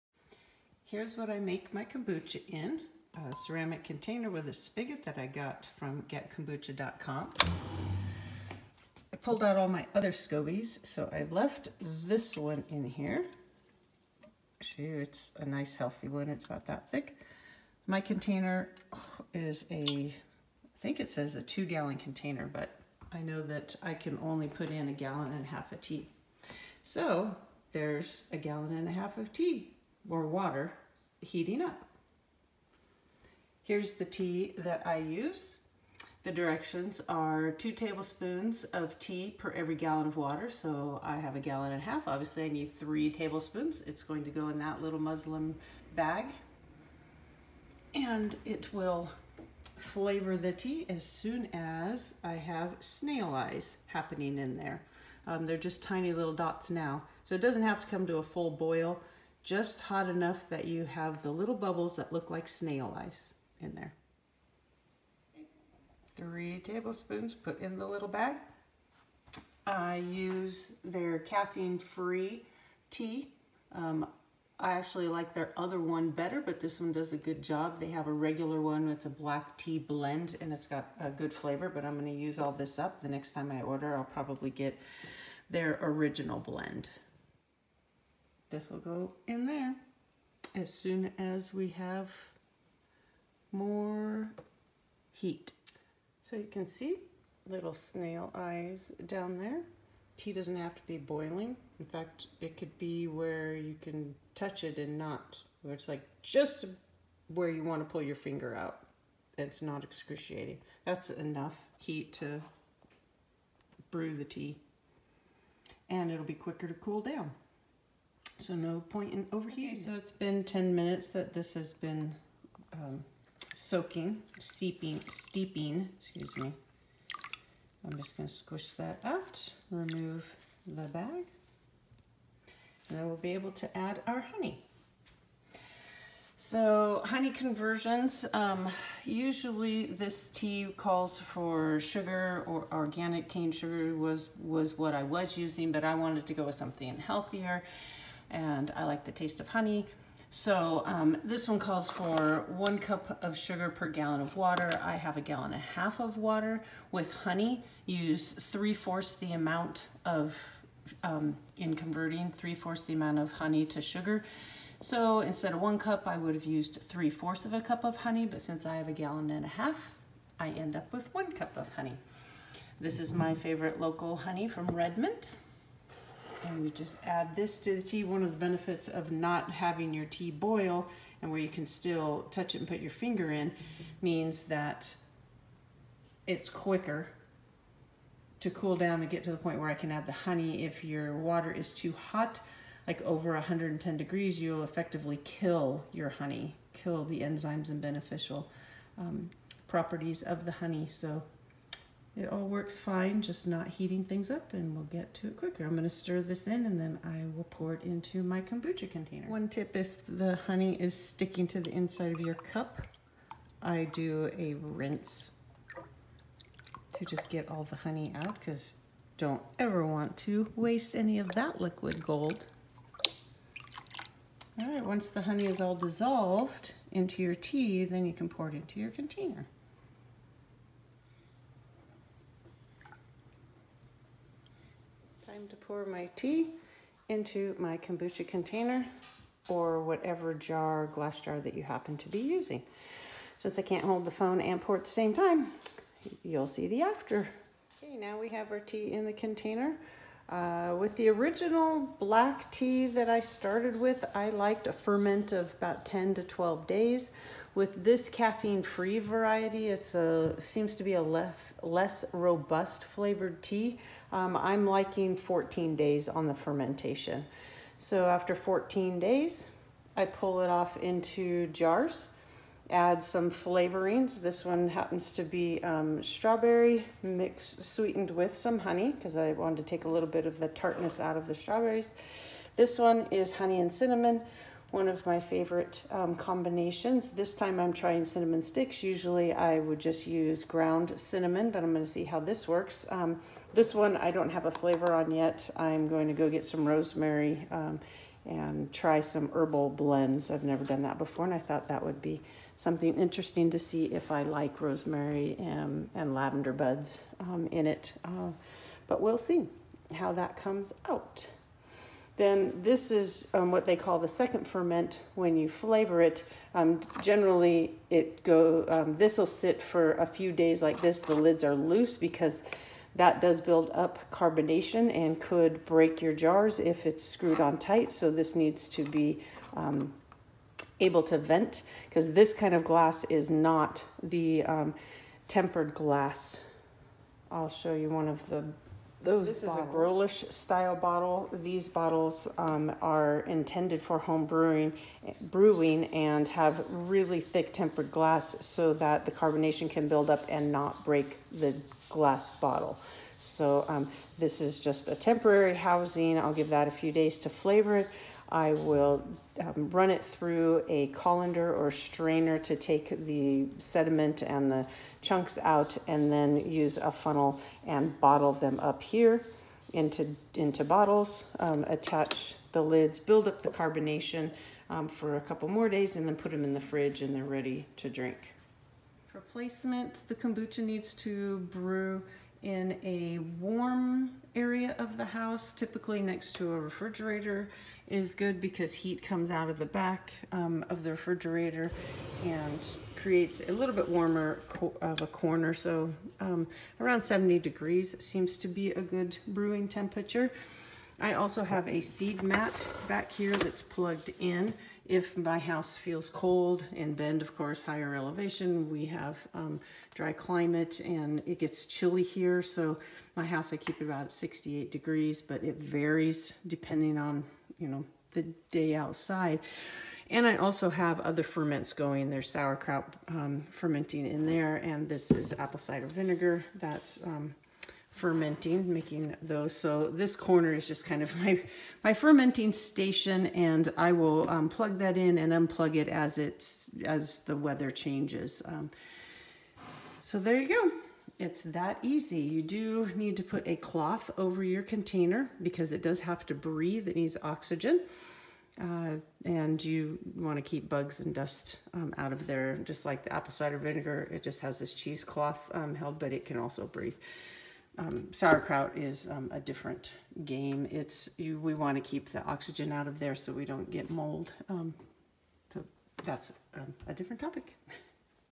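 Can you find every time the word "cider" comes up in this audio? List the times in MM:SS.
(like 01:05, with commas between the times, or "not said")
07:05, 07:33.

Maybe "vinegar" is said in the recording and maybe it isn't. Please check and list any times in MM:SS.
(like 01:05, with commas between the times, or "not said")
07:05, 07:33.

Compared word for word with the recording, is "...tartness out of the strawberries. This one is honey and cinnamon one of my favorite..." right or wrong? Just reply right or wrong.
right.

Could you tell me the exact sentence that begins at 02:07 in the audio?
I'm just gonna squish that out, remove the bag, and then we'll be able to add our honey.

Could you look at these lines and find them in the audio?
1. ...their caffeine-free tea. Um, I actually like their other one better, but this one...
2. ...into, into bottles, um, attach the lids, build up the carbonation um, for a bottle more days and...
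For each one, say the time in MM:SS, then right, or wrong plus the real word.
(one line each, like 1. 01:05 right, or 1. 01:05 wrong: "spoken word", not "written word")
1. 01:10 right
2. 06:09 wrong: "couple", not "bottle".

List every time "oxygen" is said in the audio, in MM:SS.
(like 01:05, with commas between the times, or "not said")
07:27, 07:42.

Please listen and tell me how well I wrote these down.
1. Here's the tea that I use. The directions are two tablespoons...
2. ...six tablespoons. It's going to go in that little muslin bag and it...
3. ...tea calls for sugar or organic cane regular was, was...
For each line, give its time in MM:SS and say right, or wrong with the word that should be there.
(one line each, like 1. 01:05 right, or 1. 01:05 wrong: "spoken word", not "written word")
1. 00:33 right
2. 00:42 wrong: "three", not "six"
3. 02:20 wrong: "sugar", not "regular".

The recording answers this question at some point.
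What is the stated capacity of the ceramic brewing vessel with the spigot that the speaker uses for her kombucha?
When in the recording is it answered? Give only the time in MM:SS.
00:21.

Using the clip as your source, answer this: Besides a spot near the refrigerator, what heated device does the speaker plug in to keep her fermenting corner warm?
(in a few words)
seed mat.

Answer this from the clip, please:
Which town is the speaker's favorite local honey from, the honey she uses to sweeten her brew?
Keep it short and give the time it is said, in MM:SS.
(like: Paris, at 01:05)
Redmond, at 02:54.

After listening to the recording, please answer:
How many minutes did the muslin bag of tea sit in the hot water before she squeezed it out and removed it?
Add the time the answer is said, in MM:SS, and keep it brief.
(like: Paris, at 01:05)
10, at 02:00.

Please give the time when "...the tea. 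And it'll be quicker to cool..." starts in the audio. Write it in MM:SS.
01:54.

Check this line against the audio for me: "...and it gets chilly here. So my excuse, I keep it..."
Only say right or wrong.
wrong.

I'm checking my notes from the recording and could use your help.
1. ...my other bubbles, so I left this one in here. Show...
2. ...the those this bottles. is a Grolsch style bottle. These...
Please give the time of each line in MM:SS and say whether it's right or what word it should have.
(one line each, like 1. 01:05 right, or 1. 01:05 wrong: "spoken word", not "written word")
1. 00:09 wrong: "scobies", not "bubbles"
2. 05:38 right.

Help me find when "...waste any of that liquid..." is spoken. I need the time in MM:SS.
03:40.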